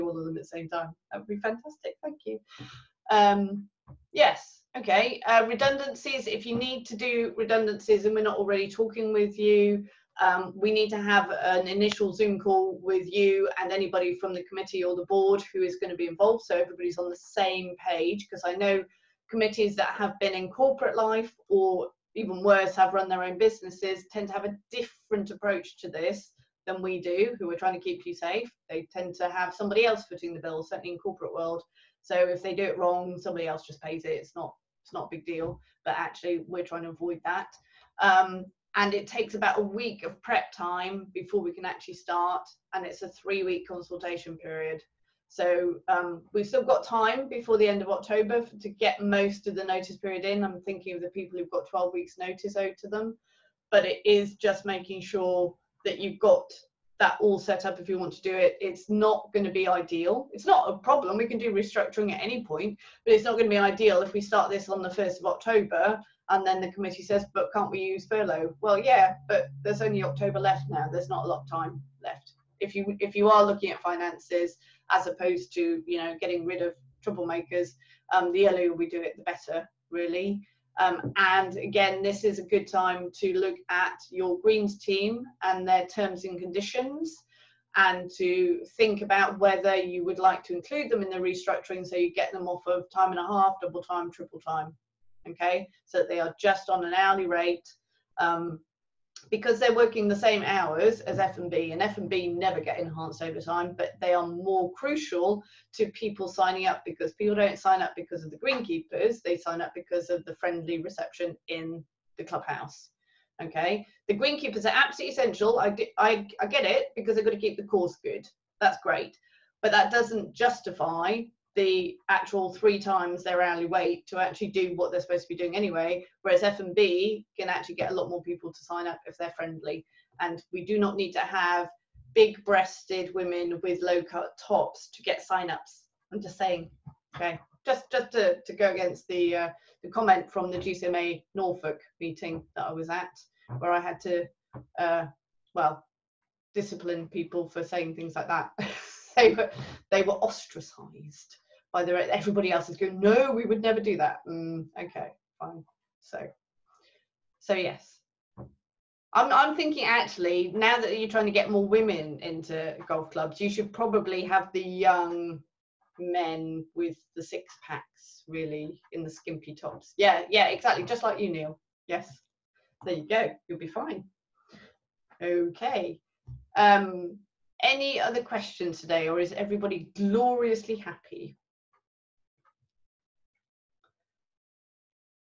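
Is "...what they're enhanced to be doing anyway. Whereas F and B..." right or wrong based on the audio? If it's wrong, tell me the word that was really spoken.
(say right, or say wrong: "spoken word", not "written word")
wrong: "supposed", not "enhanced".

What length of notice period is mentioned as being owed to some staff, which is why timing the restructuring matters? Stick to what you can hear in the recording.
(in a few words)
12 weeks.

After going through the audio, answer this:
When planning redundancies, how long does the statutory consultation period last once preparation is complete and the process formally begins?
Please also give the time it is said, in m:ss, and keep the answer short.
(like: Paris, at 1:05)
3 weeks, at 0:43.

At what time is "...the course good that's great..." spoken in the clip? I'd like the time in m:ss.
1:57.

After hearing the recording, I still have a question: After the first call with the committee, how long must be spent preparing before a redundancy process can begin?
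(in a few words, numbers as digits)
About 1 week.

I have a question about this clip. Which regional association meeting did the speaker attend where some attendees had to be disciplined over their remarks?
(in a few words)
GCMA Norfolk.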